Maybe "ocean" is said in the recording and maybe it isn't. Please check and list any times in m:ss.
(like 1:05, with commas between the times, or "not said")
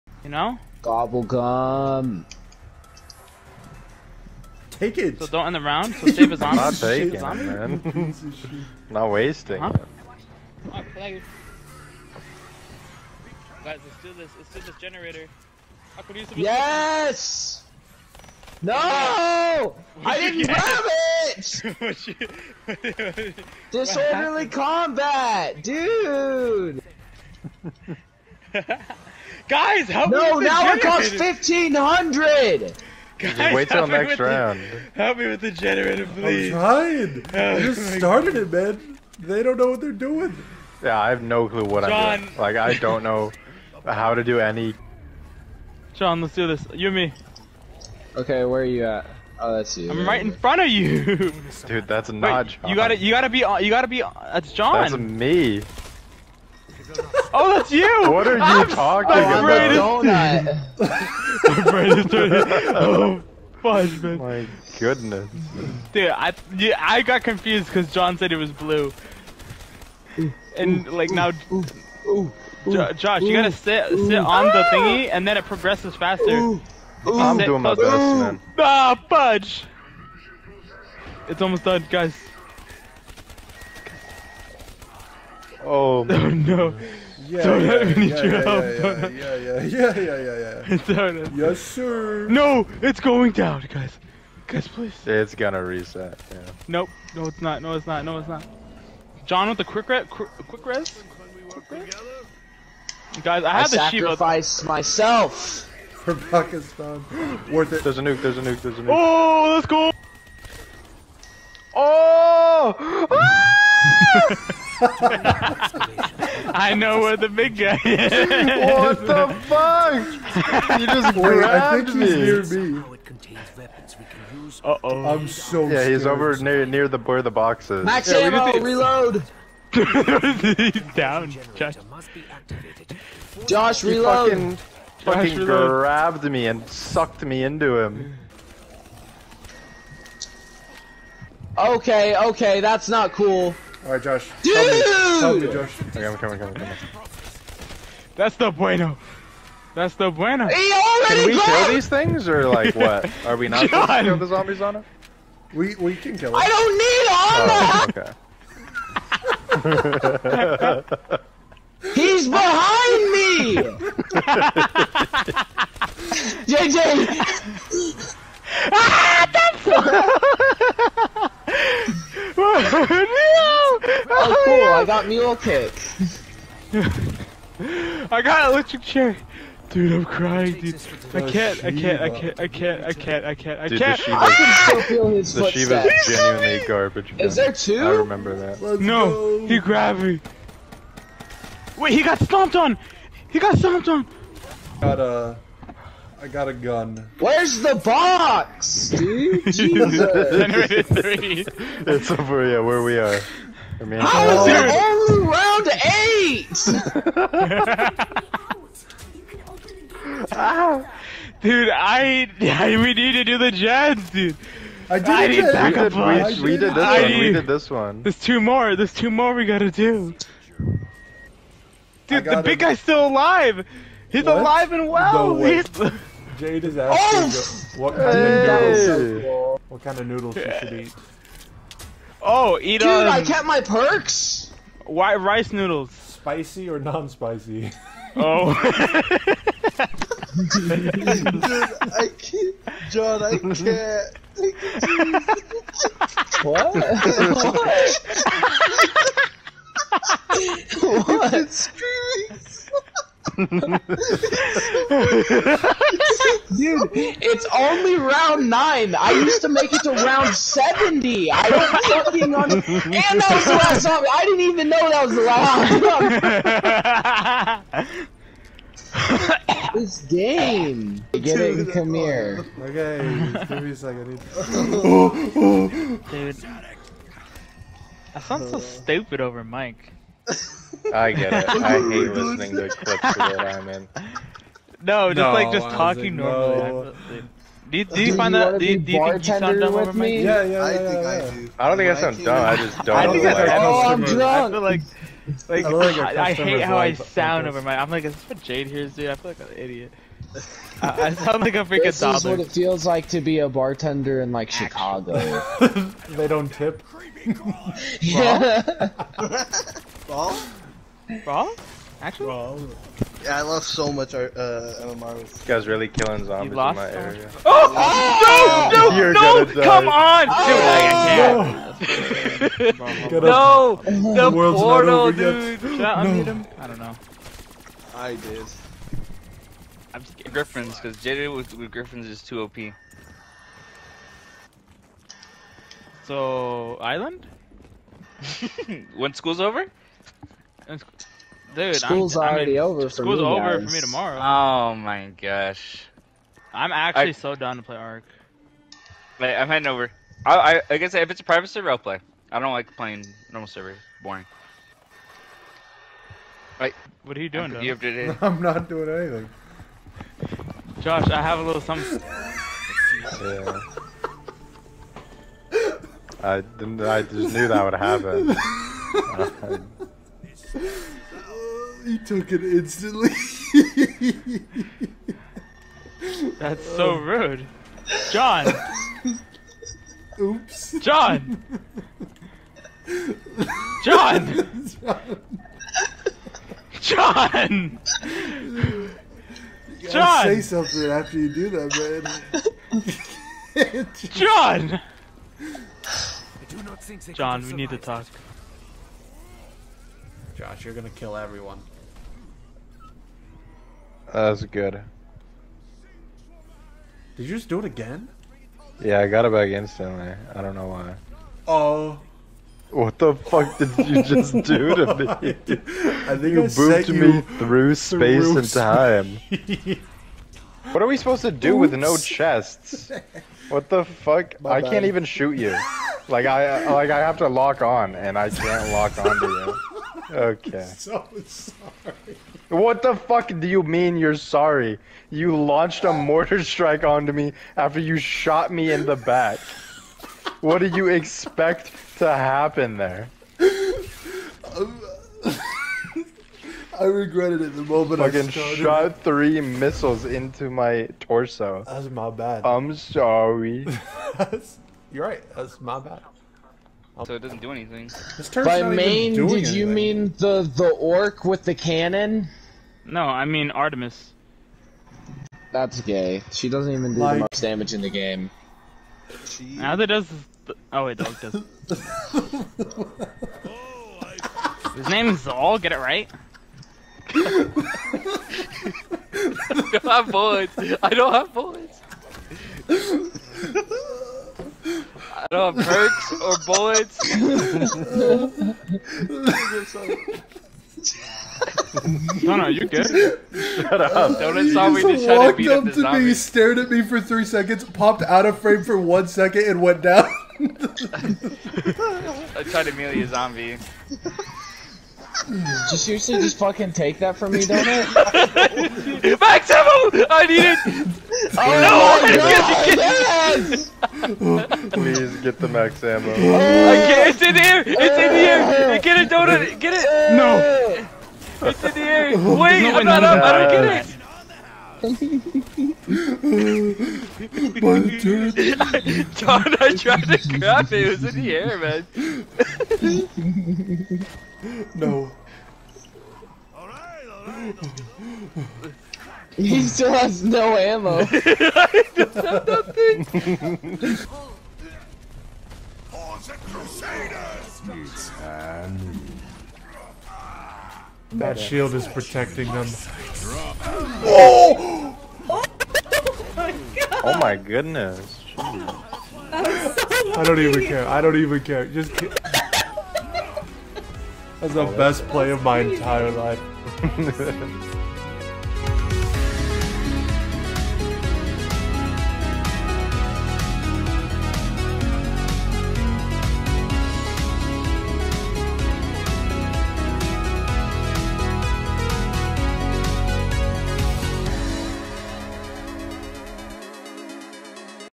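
not said.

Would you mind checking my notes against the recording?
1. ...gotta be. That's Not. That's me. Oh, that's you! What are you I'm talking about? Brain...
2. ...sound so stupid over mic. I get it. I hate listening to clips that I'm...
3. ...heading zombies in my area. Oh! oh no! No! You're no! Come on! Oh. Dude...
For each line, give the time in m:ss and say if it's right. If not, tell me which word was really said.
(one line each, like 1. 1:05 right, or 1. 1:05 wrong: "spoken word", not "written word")
1. 0:53 wrong: "John", not "Not"
2. 4:38 right
3. 5:15 wrong: "killing", not "heading".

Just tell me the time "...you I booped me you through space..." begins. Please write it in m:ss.
6:56.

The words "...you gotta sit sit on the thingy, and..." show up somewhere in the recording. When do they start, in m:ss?
1:13.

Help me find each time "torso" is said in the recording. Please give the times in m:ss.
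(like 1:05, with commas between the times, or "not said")
7:30.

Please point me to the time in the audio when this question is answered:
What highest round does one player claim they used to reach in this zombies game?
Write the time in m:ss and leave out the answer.
4:19.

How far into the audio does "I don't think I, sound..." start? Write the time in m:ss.
4:51.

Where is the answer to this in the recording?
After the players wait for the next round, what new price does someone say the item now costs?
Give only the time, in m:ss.
0:31.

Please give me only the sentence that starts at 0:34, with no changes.
The, help me with the generator, please.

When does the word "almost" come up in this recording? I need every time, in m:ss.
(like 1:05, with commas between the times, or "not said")
1:21.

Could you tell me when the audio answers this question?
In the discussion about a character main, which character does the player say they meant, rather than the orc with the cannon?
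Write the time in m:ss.
7:43.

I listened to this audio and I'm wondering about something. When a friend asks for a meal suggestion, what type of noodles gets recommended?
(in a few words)
Rice noodles.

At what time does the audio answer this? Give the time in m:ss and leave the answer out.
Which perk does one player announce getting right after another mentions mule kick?
2:58.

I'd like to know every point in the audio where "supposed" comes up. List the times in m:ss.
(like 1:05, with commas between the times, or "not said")
2:33, 7:00.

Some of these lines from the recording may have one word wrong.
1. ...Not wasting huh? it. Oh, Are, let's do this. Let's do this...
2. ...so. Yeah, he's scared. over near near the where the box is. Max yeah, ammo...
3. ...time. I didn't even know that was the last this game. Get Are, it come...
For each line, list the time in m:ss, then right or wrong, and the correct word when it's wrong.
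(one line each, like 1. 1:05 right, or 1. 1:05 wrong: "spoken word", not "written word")
1. 0:08 wrong: "Guys", not "Are"
2. 2:05 right
3. 4:23 wrong: "Dude", not "Are".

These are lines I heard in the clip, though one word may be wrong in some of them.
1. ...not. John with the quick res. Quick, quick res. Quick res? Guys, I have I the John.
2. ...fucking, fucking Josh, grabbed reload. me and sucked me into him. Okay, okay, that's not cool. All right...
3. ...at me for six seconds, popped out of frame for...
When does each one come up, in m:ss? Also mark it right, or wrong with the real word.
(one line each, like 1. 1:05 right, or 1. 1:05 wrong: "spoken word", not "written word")
1. 1:38 wrong: "Shiva", not "John"
2. 2:14 right
3. 8:16 wrong: "three", not "six".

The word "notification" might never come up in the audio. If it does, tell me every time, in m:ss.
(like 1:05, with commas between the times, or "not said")
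not said.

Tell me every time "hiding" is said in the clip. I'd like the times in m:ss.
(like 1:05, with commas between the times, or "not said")
not said.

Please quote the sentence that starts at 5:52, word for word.
I don't like playing normal server.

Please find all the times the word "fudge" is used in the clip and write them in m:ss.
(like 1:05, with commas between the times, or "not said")
1:03, 1:19.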